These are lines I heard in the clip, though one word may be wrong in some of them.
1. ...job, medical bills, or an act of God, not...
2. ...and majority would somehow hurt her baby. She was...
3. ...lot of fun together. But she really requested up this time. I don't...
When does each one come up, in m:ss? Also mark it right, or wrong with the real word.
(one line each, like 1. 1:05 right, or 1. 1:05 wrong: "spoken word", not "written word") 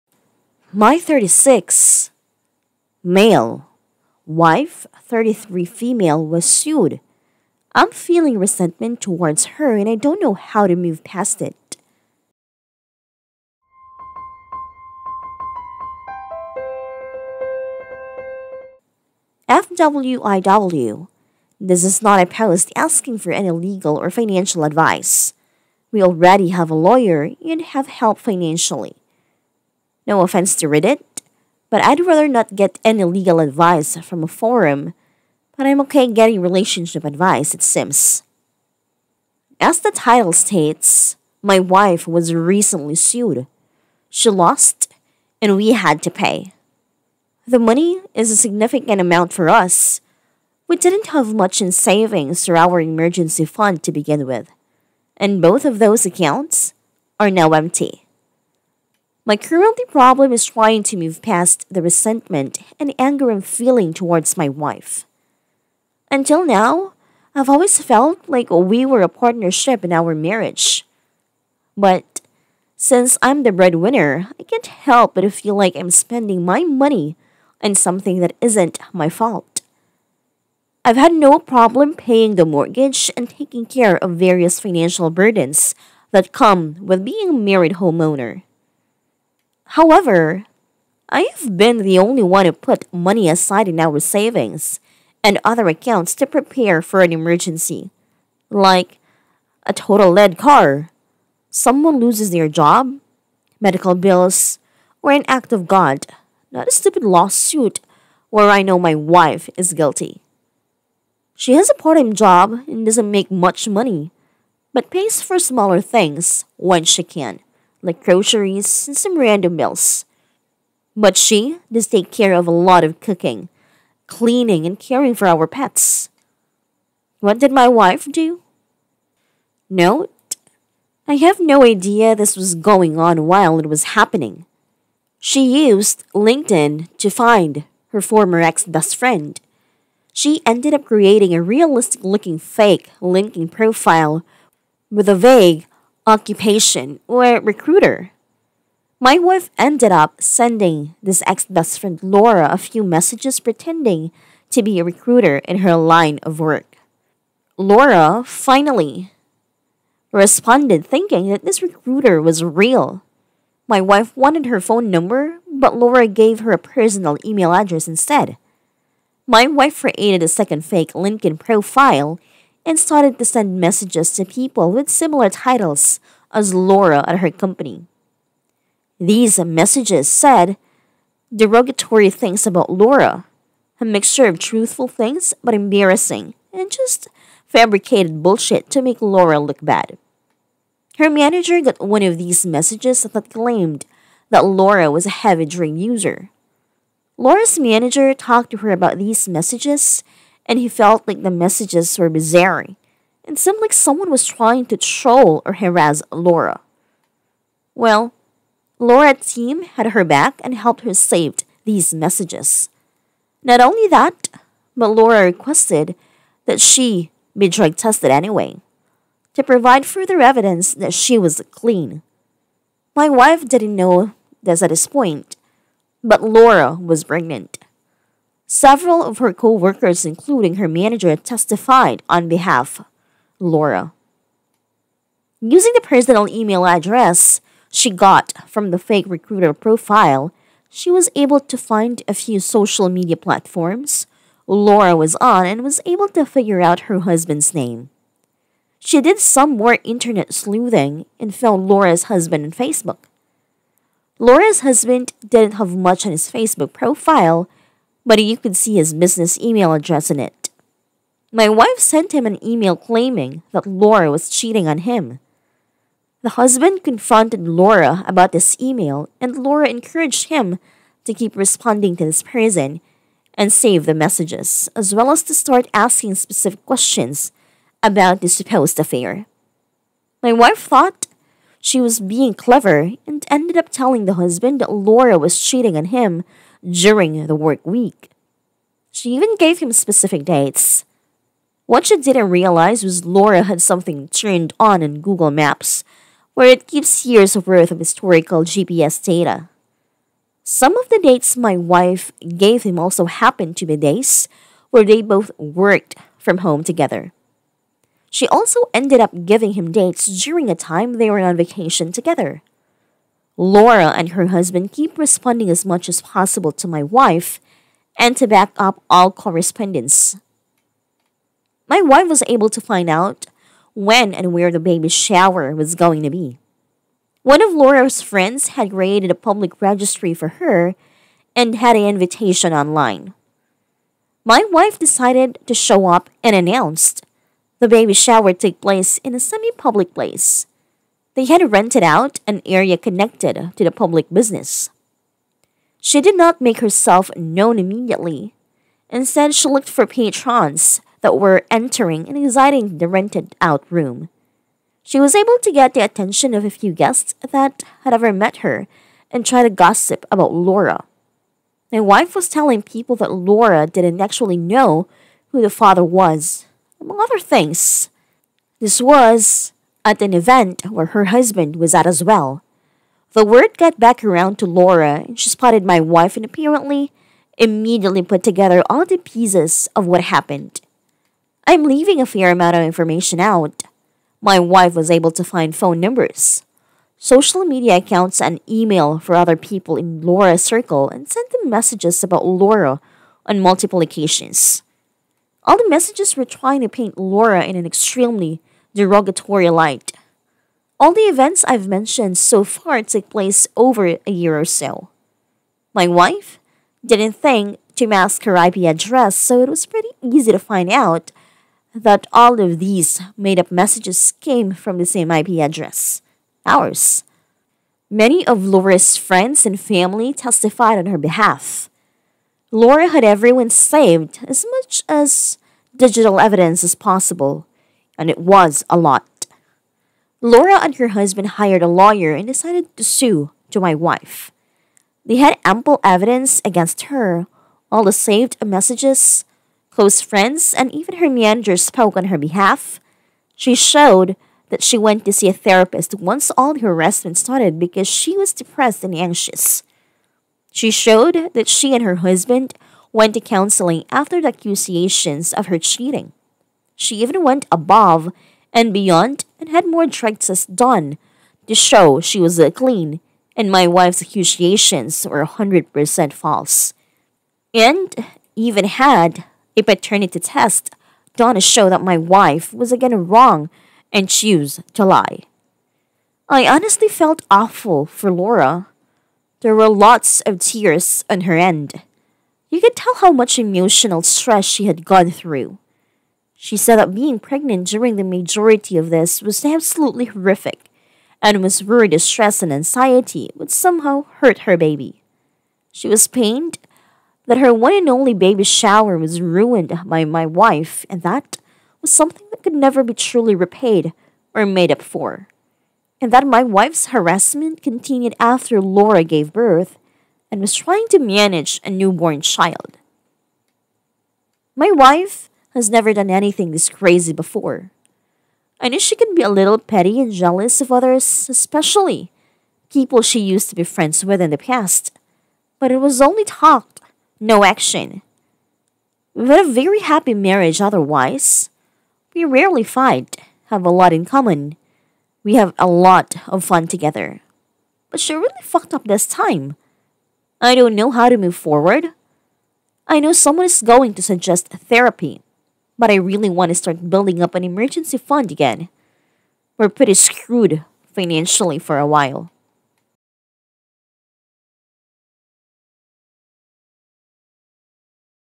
1. 1:42 right
2. 8:12 wrong: "anxiety", not "majority"
3. 8:55 wrong: "fucked", not "requested".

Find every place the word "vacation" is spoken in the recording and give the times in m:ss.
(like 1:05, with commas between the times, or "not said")
5:11.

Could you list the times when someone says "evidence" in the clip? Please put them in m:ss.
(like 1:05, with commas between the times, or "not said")
3:40, 7:06, 7:15.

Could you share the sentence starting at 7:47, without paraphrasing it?
And even had a paternity test done to show that my wife was again wrong and choose to lie.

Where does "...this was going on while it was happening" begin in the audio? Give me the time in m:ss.
2:12.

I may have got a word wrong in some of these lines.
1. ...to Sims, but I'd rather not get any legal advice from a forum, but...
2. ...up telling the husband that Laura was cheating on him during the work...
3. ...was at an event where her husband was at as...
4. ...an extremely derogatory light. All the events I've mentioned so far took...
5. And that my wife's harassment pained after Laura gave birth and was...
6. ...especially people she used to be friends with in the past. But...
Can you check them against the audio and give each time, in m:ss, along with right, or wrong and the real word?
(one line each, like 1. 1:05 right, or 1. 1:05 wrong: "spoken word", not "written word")
1. 0:30 wrong: "Reddit", not "Sims"
2. 4:43 right
3. 6:08 right
4. 6:37 right
5. 8:26 wrong: "continued", not "pained"
6. 8:41 right.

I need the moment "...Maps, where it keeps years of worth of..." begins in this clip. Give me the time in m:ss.
4:55.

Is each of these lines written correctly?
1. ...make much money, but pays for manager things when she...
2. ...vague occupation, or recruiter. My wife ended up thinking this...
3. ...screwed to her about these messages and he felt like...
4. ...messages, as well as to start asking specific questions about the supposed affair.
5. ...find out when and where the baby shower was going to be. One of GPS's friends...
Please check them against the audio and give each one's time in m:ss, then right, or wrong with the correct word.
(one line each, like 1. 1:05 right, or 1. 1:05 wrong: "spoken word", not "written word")
1. 1:53 wrong: "smaller", not "manager"
2. 2:25 wrong: "sending", not "thinking"
3. 3:18 wrong: "talked", not "screwed"
4. 4:33 right
5. 5:22 wrong: "Laura", not "GPS".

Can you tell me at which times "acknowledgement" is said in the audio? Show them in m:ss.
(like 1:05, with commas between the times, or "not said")
not said.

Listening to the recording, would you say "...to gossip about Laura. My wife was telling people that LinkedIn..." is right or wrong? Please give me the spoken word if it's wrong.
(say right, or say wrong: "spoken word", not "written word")
wrong: "Laura", not "LinkedIn".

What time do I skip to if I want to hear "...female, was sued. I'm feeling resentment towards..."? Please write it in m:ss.
0:05.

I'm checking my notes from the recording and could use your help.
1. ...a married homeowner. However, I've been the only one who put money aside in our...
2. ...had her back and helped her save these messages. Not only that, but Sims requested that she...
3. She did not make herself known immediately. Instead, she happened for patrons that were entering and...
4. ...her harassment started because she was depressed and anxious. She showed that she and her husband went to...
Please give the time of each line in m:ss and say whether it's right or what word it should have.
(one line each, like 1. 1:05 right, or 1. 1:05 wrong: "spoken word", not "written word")
1. 1:27 right
2. 3:29 wrong: "Laura", not "Sims"
3. 5:45 wrong: "looked", not "happened"
4. 7:26 right.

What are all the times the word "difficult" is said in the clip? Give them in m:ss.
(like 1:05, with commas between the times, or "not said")
not said.